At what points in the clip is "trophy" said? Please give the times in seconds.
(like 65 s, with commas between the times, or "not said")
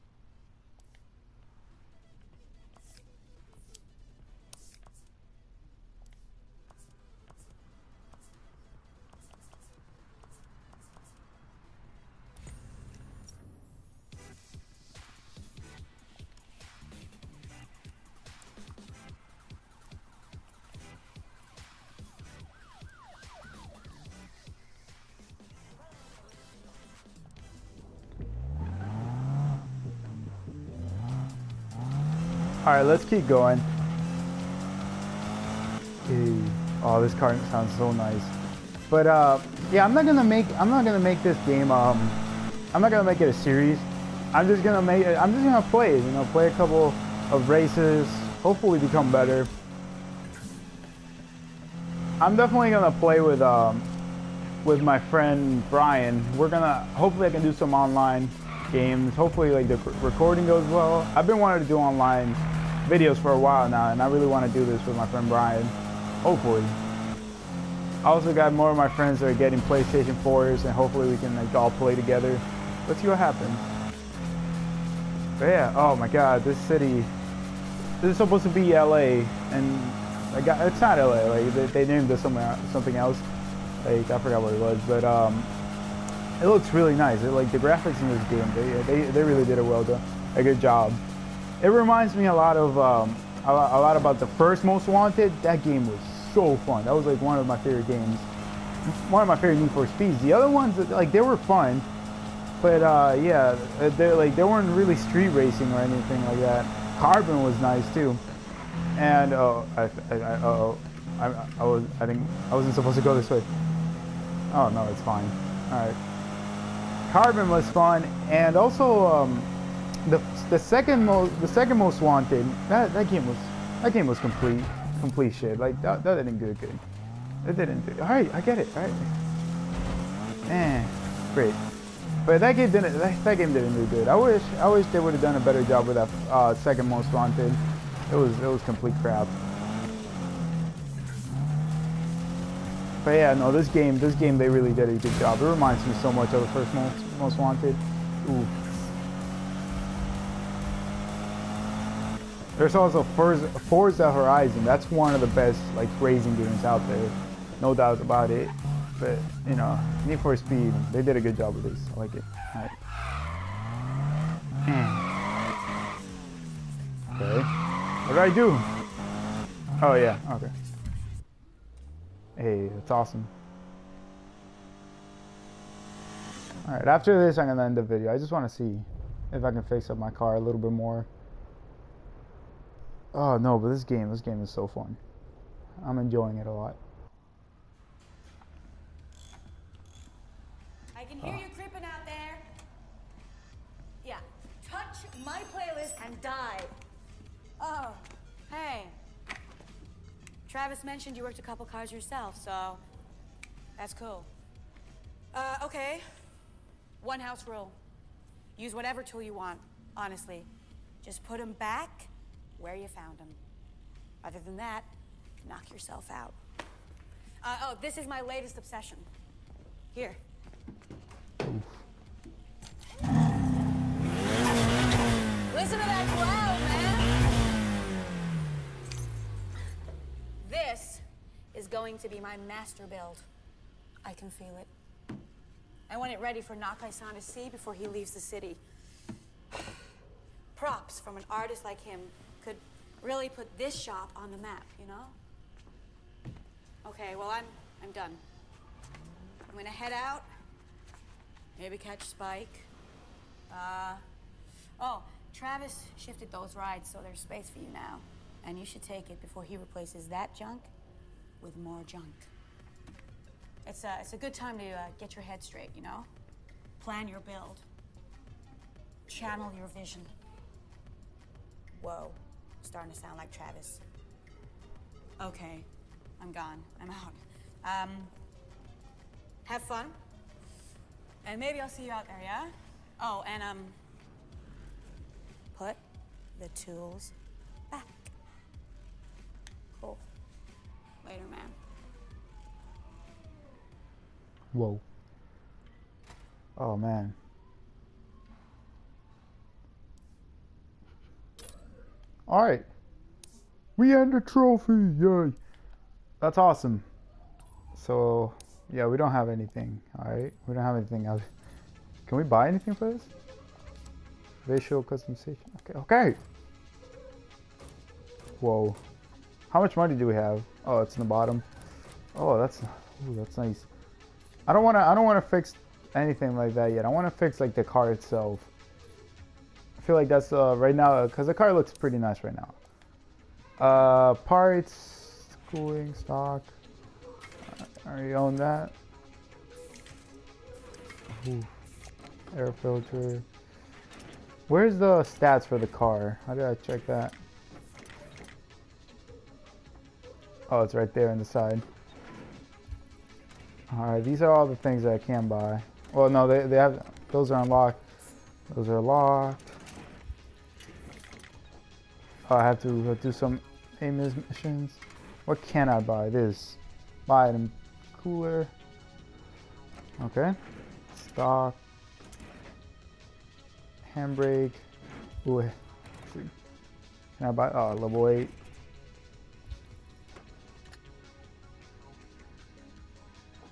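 304 s.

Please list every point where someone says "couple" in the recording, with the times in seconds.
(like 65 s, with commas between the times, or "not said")
46 s, 201 s.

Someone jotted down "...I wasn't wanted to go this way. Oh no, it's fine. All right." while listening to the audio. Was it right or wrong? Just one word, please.
wrong.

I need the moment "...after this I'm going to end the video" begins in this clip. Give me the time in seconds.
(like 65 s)
176 s.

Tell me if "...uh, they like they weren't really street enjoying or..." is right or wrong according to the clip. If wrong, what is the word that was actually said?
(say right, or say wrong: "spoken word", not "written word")
wrong: "racing", not "enjoying".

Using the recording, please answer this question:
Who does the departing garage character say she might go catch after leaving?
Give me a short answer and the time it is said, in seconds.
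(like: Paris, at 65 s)
Spike, at 252 s.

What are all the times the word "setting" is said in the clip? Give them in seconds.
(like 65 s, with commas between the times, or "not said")
not said.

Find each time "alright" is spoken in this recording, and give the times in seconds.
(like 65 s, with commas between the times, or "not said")
176 s, 302 s, 309 s, 353 s.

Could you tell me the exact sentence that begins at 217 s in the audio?
Uh, oh, this is my latest obsession.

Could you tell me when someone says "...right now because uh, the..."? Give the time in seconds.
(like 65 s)
330 s.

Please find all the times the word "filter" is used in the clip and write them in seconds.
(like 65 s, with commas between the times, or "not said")
342 s.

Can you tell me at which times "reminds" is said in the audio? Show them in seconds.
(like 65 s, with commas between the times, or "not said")
91 s, 145 s.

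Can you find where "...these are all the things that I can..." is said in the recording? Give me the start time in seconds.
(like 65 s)
354 s.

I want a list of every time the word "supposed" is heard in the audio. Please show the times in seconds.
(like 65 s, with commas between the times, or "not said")
78 s, 112 s.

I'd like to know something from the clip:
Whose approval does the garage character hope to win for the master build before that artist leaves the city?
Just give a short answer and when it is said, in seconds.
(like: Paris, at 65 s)
Nakai-san, at 236 s.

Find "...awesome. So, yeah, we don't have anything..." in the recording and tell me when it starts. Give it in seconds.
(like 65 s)
306 s.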